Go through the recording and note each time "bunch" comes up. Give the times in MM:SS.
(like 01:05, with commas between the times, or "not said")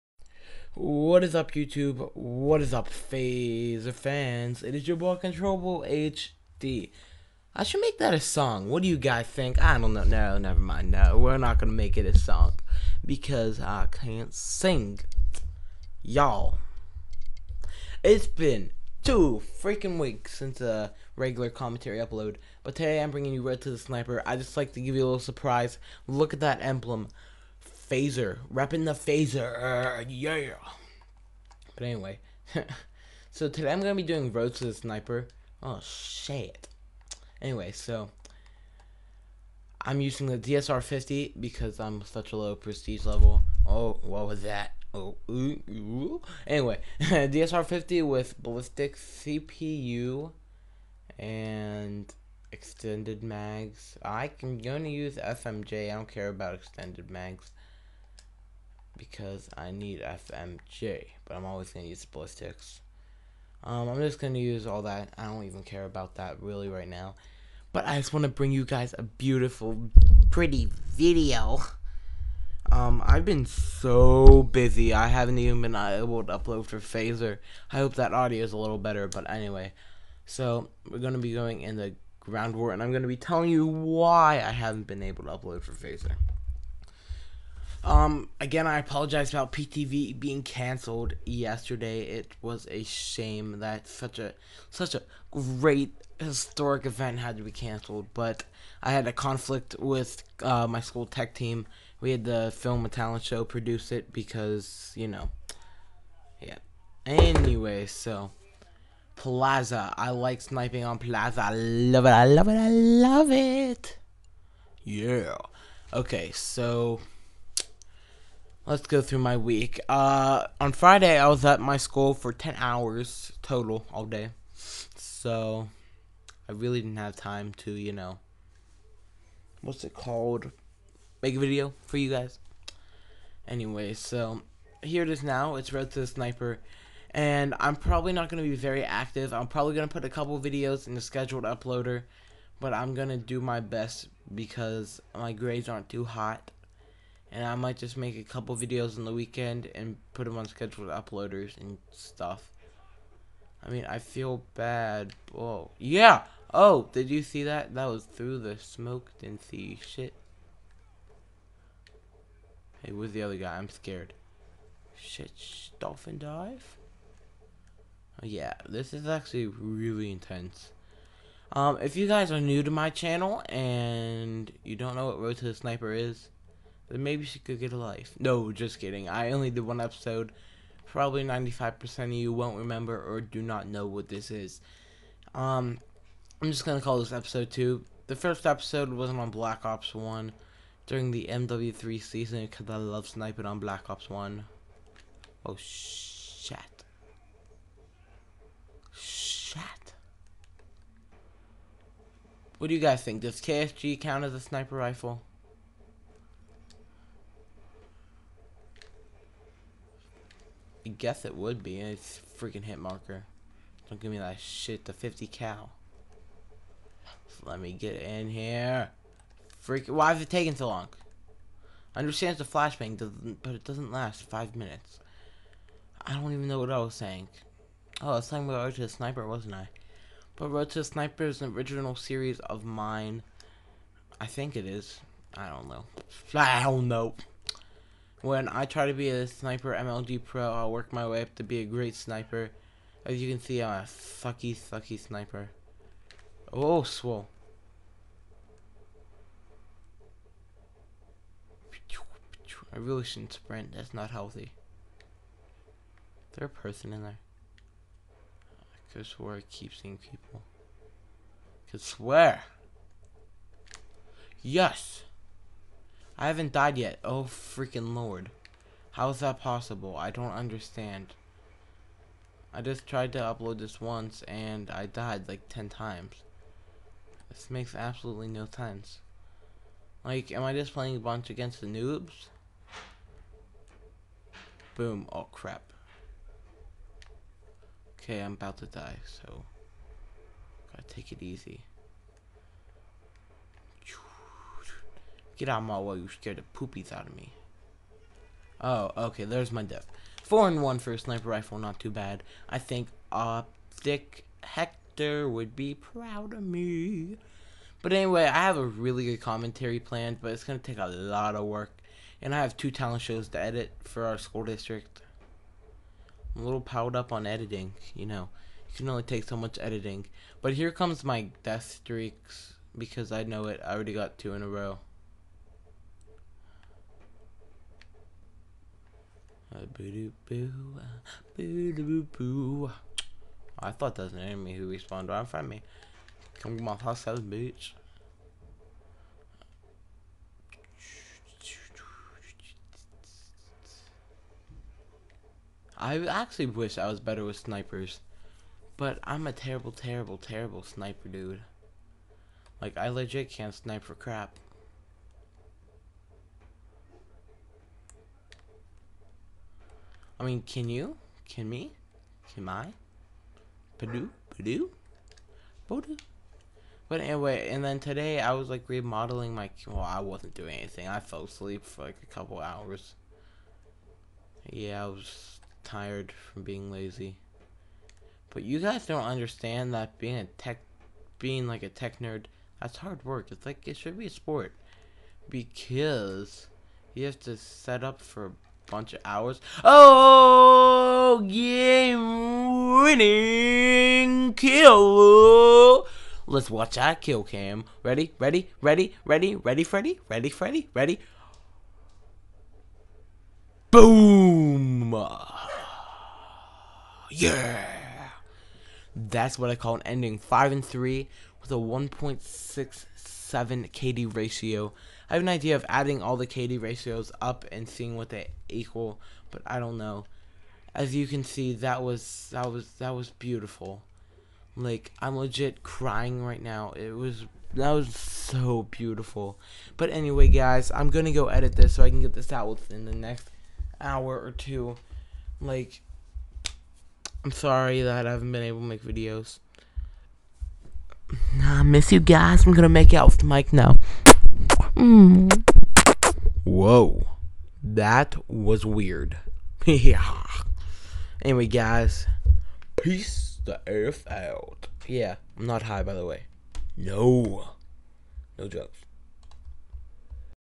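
04:40, 06:28.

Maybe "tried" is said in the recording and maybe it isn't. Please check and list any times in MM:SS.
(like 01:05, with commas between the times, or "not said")
04:32.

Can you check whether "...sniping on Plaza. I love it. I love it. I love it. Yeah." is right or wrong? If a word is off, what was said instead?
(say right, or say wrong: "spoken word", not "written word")
right.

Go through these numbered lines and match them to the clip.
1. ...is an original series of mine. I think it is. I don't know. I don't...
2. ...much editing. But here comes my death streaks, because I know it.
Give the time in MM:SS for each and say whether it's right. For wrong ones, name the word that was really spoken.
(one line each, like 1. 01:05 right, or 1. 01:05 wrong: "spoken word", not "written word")
1. 03:51 right
2. 05:19 right.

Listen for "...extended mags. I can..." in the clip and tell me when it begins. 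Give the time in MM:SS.
00:52.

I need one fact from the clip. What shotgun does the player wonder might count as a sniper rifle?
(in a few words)
KSG.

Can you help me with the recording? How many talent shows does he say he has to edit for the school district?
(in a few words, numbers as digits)
2.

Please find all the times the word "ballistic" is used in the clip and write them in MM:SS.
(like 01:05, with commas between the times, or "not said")
00:48, 01:02.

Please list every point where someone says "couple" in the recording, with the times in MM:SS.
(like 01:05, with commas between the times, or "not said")
02:20, 02:28, 06:12.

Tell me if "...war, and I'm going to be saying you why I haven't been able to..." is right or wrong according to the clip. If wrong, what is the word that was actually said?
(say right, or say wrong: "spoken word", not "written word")
wrong: "telling", not "saying".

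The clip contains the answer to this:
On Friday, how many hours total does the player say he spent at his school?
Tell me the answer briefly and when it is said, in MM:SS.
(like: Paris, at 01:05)
10, at 02:02.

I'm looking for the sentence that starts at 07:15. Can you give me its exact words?
Like, I'm sorry that I haven't been able to make videos.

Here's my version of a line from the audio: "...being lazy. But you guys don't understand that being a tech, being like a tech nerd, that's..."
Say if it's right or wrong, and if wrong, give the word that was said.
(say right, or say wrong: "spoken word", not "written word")
right.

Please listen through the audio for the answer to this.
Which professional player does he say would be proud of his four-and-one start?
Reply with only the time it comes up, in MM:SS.
05:03.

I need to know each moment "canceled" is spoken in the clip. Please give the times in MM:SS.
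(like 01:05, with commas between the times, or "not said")
01:30, 01:37.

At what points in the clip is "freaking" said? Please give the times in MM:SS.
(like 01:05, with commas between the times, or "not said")
00:19, 03:32, 03:39, 04:27.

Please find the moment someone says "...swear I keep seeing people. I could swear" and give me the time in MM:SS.
04:19.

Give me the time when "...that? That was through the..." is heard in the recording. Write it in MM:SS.
02:37.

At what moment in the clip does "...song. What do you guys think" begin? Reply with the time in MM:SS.
00:08.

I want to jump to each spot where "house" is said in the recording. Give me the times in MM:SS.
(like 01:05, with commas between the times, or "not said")
05:36.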